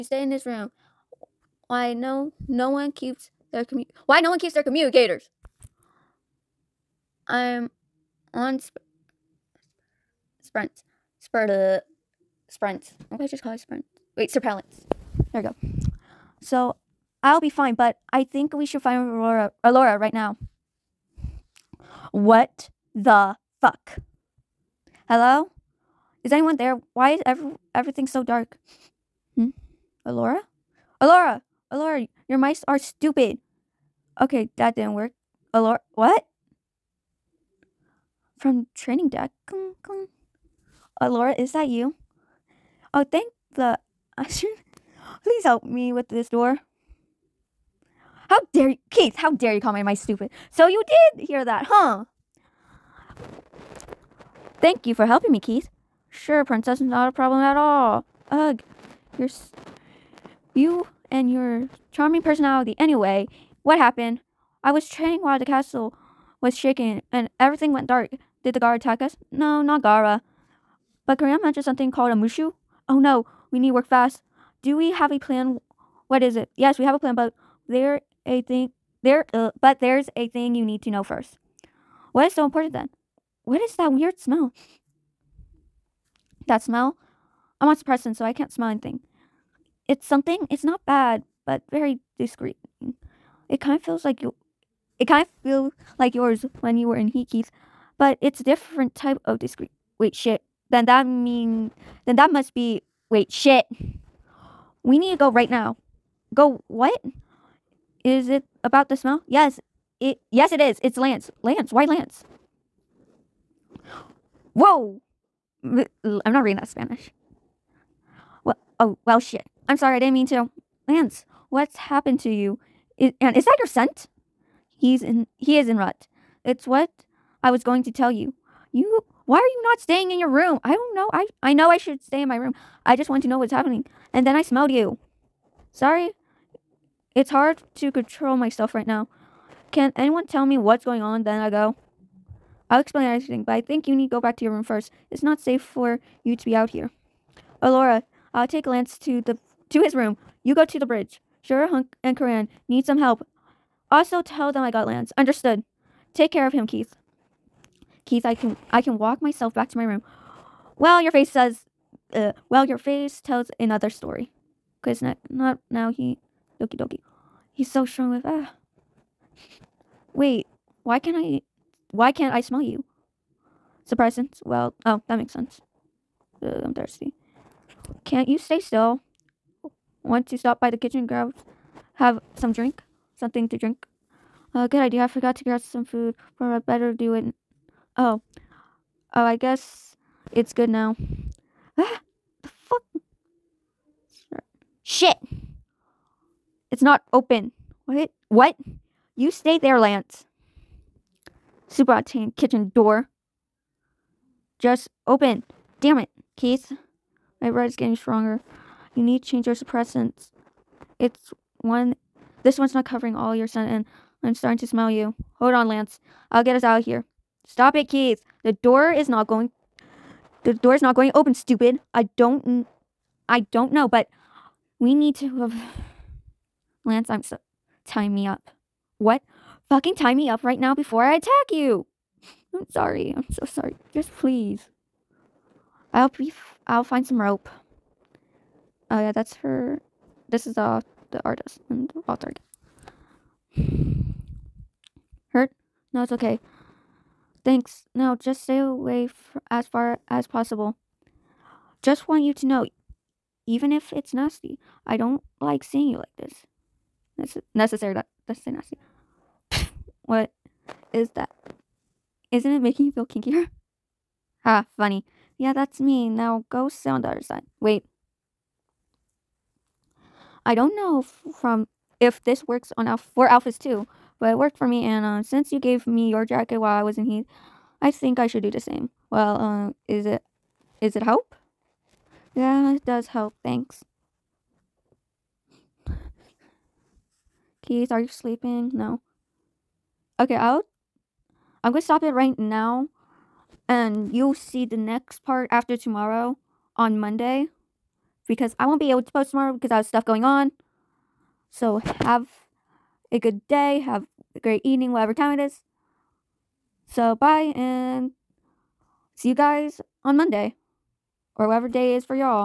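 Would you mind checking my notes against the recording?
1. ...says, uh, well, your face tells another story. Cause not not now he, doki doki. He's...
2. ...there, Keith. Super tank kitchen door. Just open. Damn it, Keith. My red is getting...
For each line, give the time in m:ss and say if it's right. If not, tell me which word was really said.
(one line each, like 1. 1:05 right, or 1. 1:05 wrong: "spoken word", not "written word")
1. 2:41 right
2. 3:19 wrong: "Lance", not "Keith".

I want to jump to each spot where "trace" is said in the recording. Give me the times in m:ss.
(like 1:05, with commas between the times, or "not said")
not said.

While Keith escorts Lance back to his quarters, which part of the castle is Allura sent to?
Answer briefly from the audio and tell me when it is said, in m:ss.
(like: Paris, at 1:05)
The bridge, at 2:30.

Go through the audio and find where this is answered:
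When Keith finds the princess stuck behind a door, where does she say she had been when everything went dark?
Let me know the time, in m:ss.
0:38.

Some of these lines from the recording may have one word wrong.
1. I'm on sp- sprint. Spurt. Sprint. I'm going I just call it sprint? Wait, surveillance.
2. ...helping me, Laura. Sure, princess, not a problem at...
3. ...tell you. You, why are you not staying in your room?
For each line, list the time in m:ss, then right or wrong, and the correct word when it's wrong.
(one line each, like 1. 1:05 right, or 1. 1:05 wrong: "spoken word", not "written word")
1. 0:07 right
2. 0:55 wrong: "Keith", not "Laura"
3. 2:07 right.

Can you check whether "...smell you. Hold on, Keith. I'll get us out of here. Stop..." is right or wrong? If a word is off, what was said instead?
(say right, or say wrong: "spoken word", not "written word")
wrong: "Lance", not "Keith".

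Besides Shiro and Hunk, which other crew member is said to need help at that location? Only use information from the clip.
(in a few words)
Coran.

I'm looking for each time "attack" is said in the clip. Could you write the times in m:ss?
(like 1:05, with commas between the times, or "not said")
1:08, 3:51.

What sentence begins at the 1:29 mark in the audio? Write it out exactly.
It's something, it's not bad, but very discreet.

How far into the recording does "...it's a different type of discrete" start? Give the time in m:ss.
1:38.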